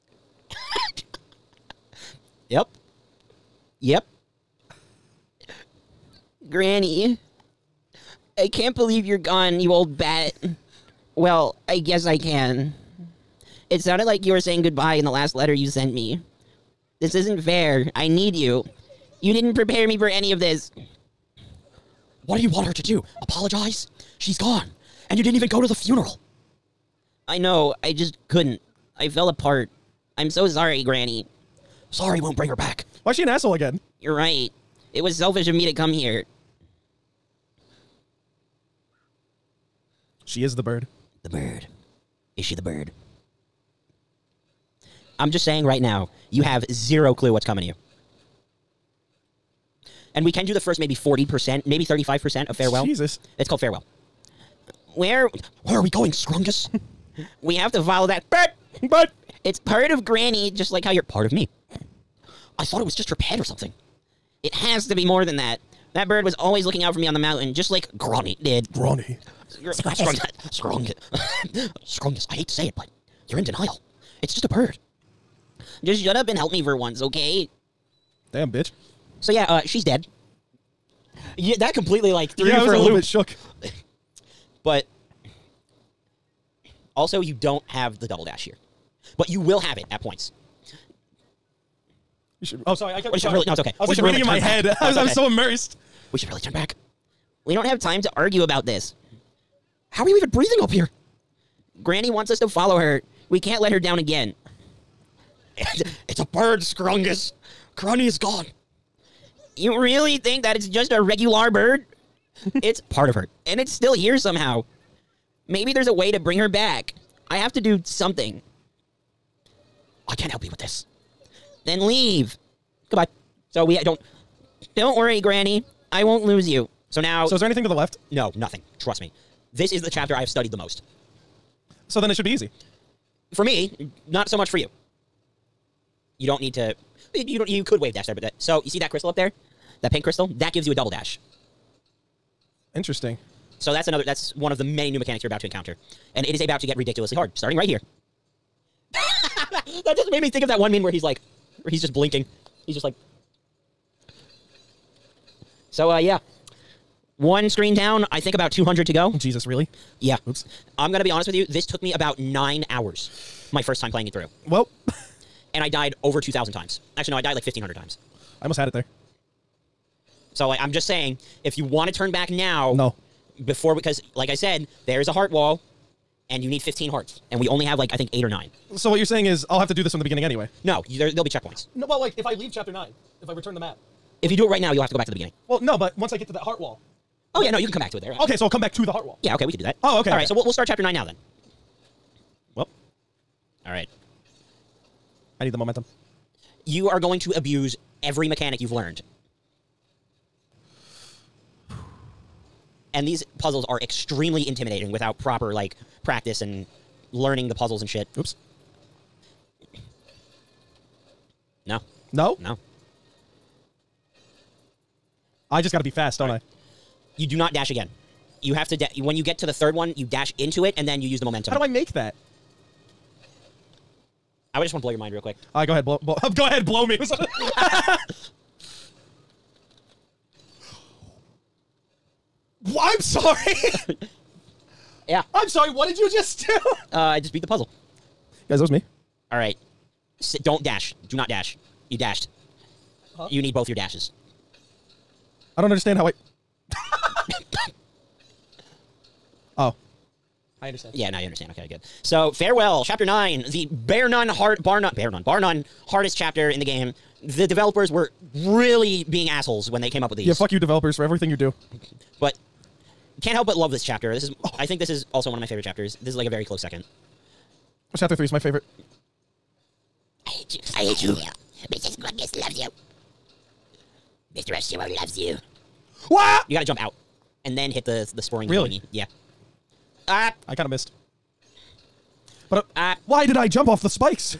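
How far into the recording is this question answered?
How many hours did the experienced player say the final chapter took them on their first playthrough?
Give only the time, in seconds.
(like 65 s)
162 s.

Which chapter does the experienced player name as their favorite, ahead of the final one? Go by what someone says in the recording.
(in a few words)
Chapter 3.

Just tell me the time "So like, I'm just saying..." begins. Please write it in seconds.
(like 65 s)
170 s.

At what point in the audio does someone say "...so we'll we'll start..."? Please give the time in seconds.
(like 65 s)
190 s.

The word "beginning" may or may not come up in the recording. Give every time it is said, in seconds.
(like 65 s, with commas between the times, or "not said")
180 s, 185 s.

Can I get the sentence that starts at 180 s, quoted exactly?
No, you, there there'll be checkpoints.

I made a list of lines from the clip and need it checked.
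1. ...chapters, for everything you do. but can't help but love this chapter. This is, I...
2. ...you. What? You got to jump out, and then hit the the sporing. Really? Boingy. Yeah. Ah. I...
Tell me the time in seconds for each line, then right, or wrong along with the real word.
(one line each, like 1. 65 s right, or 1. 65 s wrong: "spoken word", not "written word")
1. 260 s wrong: "developers", not "chapters"
2. 275 s right.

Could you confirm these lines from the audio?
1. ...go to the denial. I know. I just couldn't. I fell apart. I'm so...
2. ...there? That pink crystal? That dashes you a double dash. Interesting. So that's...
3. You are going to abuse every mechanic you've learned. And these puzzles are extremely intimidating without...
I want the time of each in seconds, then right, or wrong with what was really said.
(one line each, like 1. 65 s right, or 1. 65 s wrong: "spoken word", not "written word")
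1. 25 s wrong: "funeral", not "denial"
2. 139 s wrong: "gives", not "dashes"
3. 196 s right.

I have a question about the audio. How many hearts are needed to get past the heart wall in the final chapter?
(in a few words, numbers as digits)
15.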